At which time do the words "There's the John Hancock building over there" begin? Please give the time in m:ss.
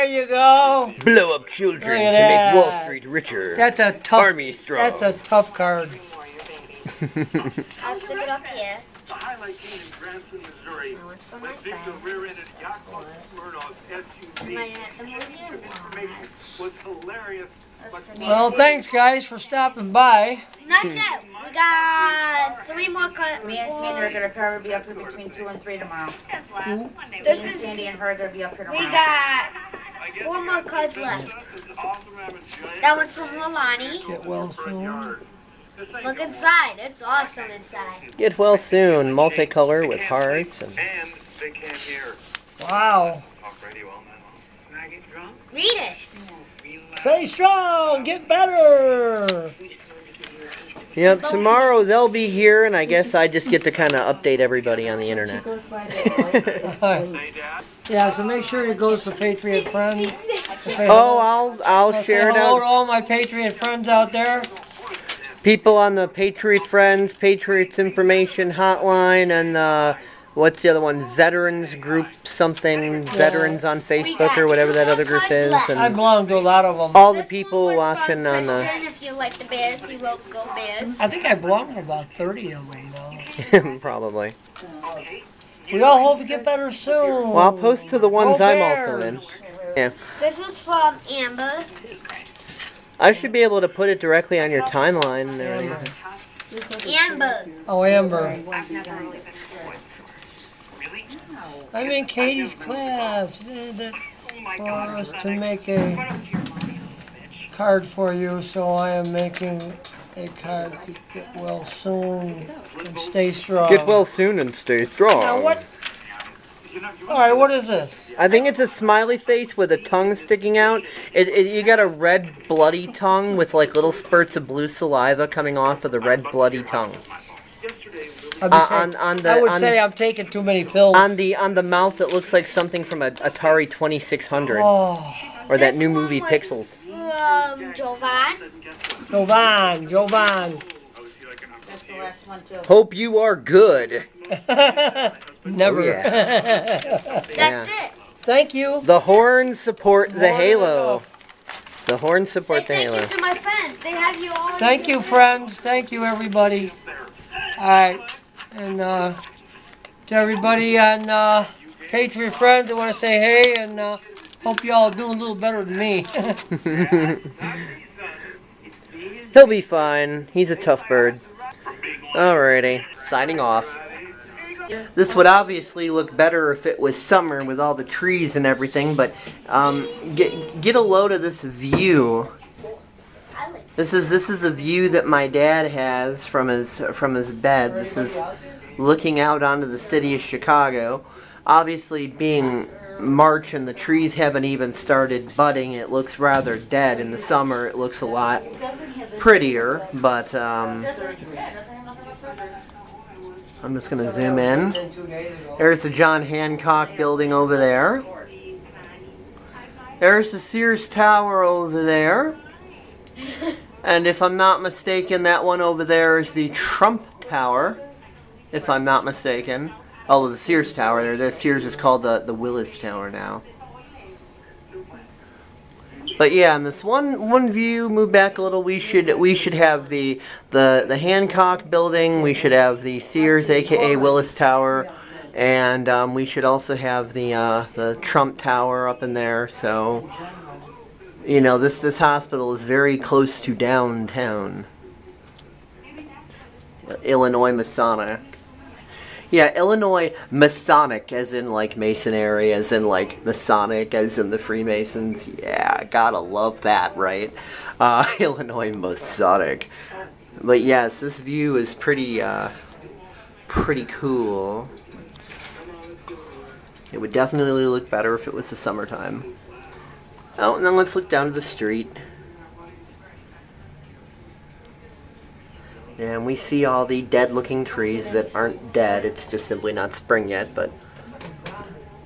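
3:25.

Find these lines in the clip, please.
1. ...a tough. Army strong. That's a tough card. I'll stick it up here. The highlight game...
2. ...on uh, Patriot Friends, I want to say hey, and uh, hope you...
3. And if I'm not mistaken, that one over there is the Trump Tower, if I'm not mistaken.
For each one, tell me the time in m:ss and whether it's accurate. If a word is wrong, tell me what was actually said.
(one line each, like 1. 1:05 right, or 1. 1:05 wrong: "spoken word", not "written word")
1. 0:03 right
2. 2:40 right
3. 3:33 right.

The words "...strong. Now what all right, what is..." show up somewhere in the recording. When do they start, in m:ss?
1:54.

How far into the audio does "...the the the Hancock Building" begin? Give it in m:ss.
3:49.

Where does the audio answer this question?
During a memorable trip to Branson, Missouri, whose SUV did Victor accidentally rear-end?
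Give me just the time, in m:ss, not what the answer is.
0:12.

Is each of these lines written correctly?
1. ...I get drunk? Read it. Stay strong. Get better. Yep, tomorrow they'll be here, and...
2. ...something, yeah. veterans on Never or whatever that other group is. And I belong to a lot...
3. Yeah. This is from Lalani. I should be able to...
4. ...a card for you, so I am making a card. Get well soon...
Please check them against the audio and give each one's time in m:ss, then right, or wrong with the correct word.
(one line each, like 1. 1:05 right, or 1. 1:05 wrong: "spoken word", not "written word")
1. 0:44 right
2. 1:12 wrong: "Facebook", not "Never"
3. 1:29 wrong: "Amber", not "Lalani"
4. 1:45 right.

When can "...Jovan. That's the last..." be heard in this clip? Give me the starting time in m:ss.
2:19.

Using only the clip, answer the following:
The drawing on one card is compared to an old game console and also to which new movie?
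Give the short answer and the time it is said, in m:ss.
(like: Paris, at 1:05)
Pixels, at 2:16.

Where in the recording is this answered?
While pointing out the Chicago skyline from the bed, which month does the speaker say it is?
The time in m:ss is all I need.
3:13.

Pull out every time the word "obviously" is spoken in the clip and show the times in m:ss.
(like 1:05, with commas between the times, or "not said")
2:55, 3:11.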